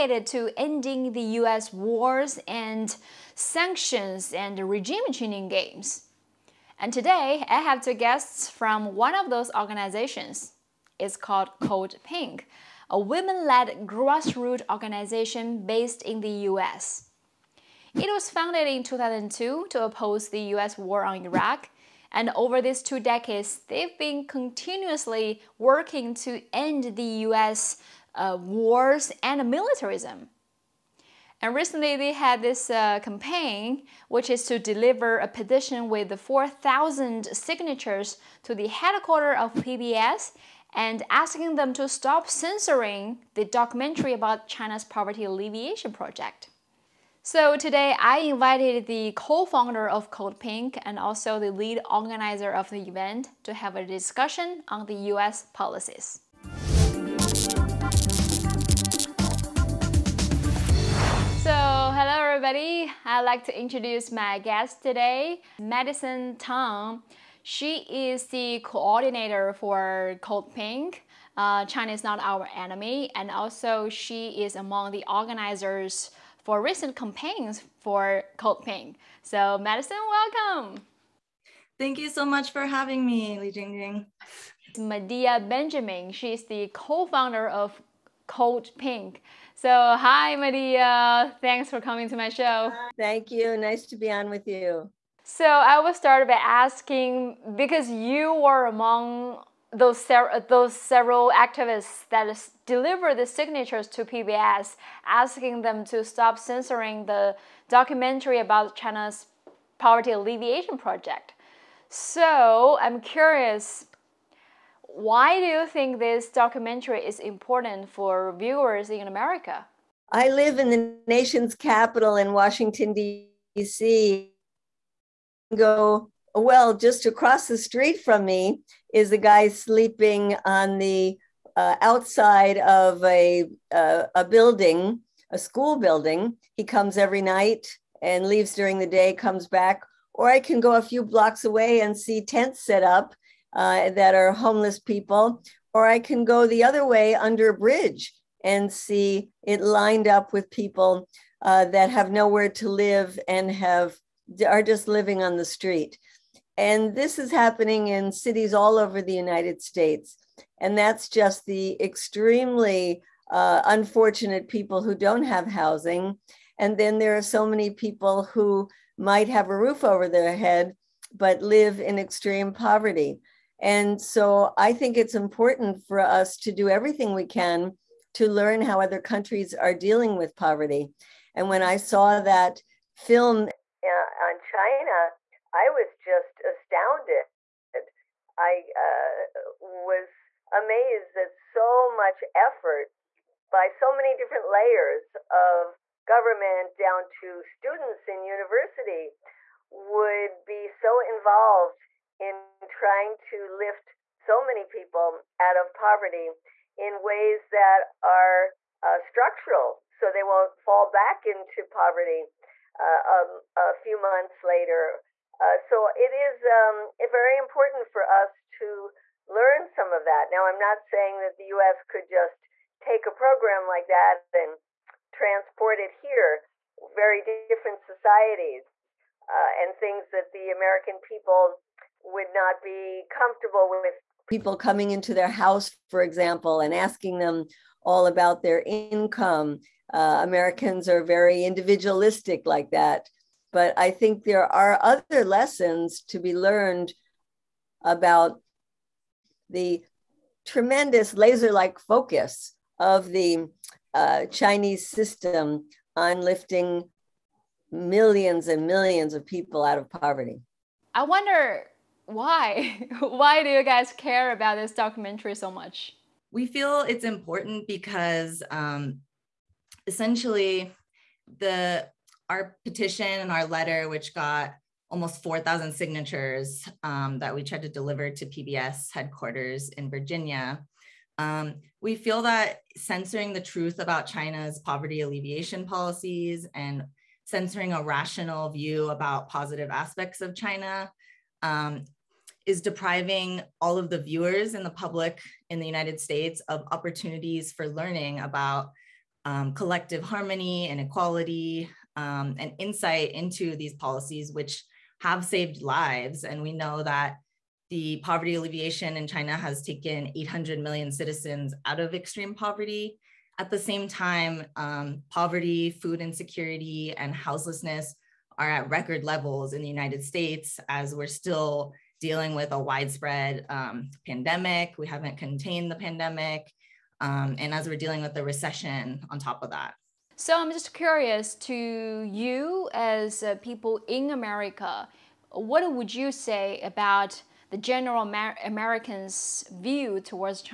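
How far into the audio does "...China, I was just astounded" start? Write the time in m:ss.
3:04.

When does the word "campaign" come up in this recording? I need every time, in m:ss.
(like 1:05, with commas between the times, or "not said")
0:33, 1:16.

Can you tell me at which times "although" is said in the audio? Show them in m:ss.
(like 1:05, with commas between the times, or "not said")
not said.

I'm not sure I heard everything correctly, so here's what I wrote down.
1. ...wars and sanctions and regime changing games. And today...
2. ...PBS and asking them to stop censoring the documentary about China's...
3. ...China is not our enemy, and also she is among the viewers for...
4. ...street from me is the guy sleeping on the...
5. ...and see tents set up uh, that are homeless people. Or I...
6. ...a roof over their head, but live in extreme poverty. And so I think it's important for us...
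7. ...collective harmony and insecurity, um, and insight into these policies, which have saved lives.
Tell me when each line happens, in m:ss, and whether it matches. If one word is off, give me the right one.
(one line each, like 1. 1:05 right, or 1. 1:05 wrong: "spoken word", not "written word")
1. 0:01 right
2. 0:39 right
3. 1:11 wrong: "organizers", not "viewers"
4. 2:07 right
5. 2:21 right
6. 2:49 right
7. 4:59 wrong: "equality", not "insecurity".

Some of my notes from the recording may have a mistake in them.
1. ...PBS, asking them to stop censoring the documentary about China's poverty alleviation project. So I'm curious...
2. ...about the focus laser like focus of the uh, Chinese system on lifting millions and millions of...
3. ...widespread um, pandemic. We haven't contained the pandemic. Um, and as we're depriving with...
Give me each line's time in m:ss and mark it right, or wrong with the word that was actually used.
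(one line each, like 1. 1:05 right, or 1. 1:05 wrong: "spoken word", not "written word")
1. 1:44 right
2. 4:07 wrong: "tremendous", not "focus"
3. 5:22 wrong: "dealing", not "depriving".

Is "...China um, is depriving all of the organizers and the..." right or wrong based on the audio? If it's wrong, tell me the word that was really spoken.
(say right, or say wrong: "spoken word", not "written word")
wrong: "viewers", not "organizers".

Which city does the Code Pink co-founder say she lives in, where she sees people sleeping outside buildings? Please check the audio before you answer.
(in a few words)
Washington, D.C.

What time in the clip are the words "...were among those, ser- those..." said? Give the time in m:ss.
1:38.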